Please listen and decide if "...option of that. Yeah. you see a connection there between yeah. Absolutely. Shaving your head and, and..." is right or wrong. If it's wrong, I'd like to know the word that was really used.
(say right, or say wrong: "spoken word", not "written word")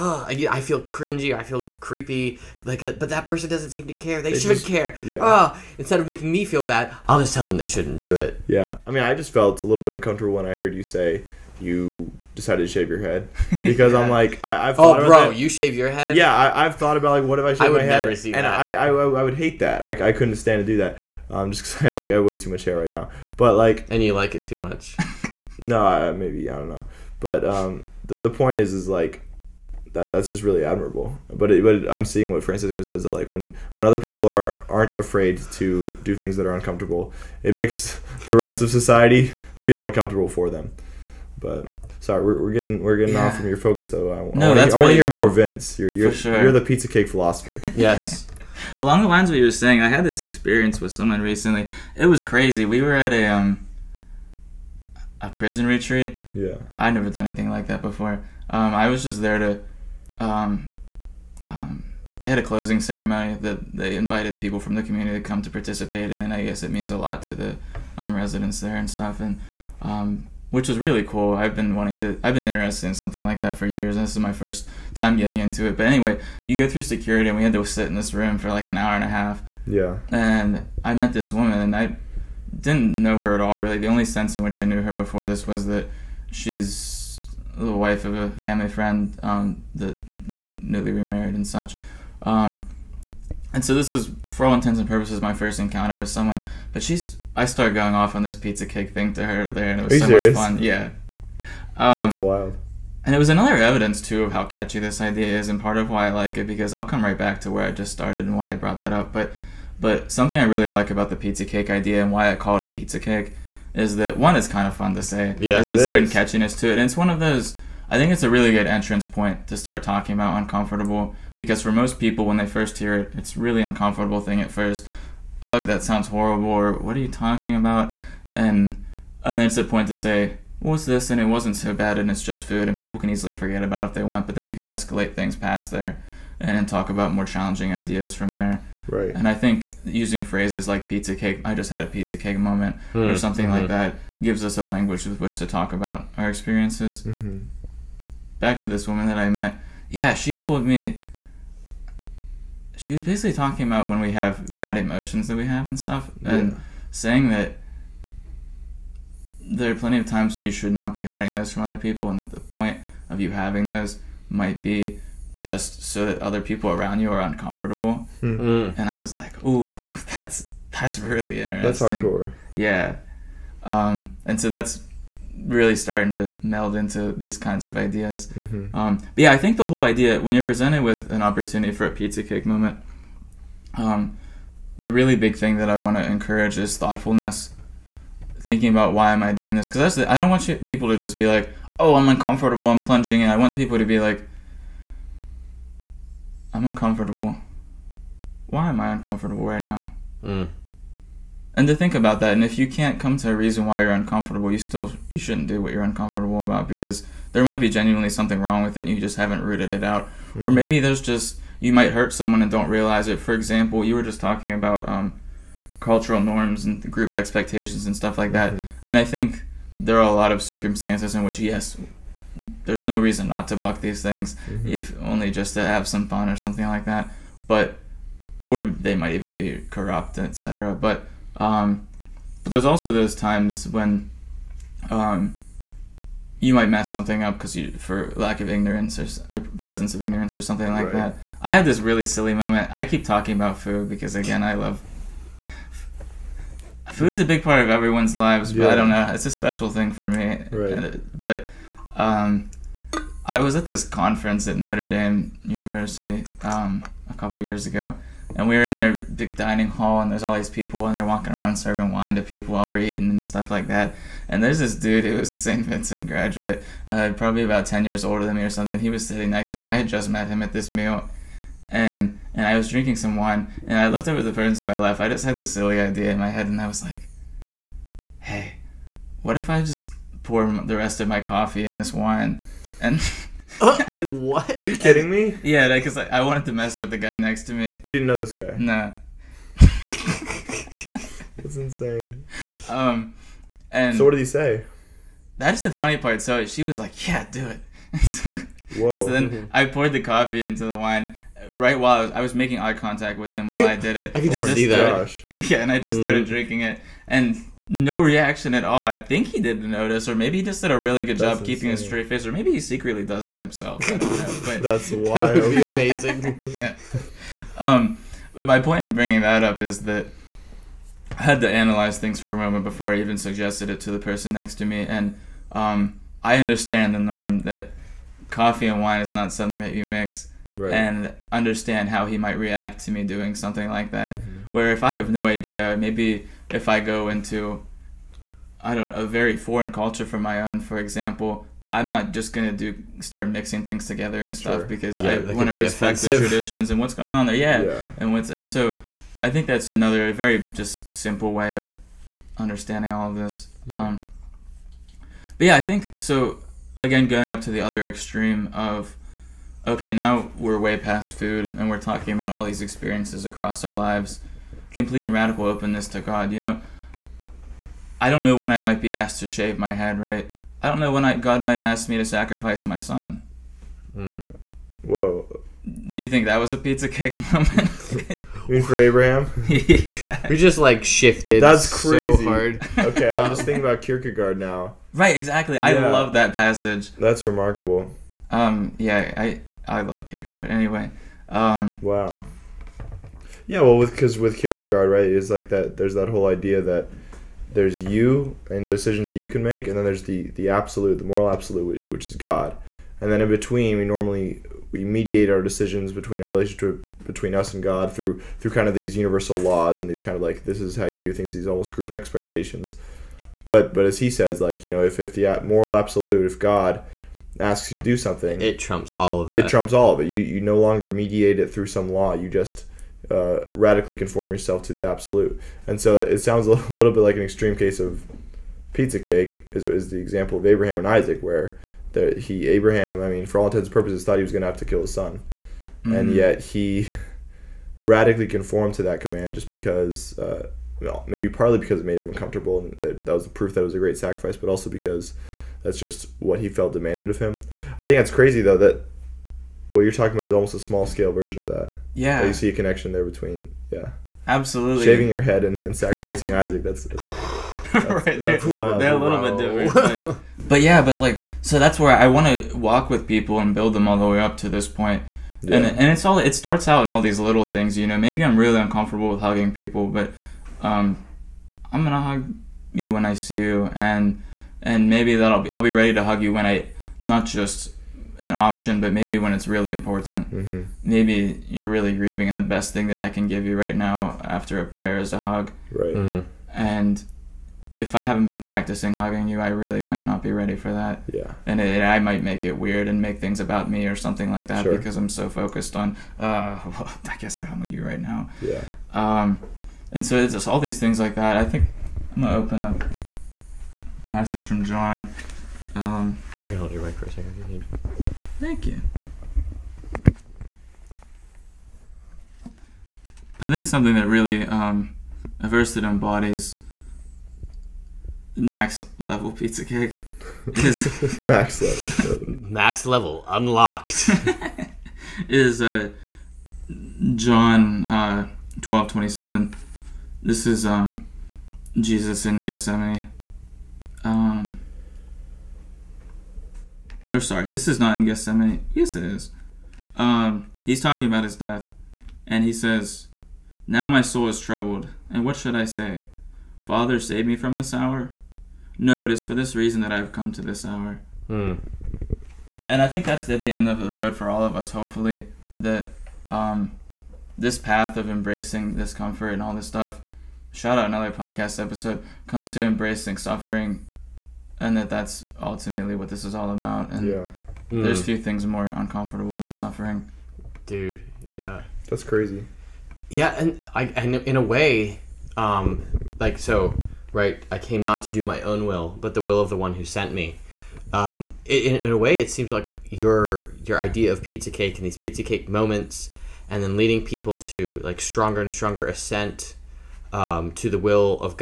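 wrong: "version", not "option".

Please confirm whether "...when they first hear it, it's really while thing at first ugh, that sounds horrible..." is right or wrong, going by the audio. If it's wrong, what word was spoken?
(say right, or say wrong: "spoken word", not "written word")
wrong: "uncomfortable", not "while".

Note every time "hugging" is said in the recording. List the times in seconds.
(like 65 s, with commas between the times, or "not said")
469 s, 488 s.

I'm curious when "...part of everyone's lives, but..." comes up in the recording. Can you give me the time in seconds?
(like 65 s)
247 s.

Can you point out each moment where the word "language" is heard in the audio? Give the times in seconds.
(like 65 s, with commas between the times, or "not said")
144 s.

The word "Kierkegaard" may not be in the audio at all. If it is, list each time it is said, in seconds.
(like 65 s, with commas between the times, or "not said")
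383 s, 390 s, 394 s.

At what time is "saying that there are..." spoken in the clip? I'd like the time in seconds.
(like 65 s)
156 s.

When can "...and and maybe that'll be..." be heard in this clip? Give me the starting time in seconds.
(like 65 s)
473 s.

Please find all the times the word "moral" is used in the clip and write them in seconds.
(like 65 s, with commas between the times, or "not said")
401 s, 415 s.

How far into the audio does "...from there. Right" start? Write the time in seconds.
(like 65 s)
138 s.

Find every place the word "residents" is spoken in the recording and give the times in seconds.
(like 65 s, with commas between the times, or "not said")
68 s.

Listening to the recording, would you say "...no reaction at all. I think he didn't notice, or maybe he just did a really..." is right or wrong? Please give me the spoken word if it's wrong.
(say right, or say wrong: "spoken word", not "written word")
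right.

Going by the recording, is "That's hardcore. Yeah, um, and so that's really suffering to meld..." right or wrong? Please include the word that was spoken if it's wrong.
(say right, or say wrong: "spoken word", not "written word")
wrong: "starting", not "suffering".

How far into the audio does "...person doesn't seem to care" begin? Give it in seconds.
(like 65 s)
3 s.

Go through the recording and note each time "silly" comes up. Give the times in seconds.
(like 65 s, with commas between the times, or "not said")
242 s, 275 s.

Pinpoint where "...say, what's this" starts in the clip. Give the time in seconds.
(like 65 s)
129 s.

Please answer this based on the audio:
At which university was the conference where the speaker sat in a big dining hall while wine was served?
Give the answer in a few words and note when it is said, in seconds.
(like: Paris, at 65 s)
Notre Dame, at 254 s.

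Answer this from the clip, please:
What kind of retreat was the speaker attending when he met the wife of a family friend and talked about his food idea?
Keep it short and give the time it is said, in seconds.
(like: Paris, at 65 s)
A prison retreat, at 55 s.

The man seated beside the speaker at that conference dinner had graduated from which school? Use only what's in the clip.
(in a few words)
St. Vincent.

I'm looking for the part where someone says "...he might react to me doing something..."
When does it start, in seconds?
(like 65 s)
332 s.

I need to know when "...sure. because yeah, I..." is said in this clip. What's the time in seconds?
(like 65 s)
344 s.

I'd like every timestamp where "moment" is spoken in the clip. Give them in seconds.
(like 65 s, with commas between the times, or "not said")
142 s, 182 s, 242 s, 322 s, 377 s, 585 s.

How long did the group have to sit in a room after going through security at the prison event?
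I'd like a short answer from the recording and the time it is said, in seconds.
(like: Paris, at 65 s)
An hour and a half, at 78 s.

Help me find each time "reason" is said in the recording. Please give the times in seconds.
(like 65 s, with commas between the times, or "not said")
203 s, 222 s, 549 s.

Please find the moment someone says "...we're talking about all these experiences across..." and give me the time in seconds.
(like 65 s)
361 s.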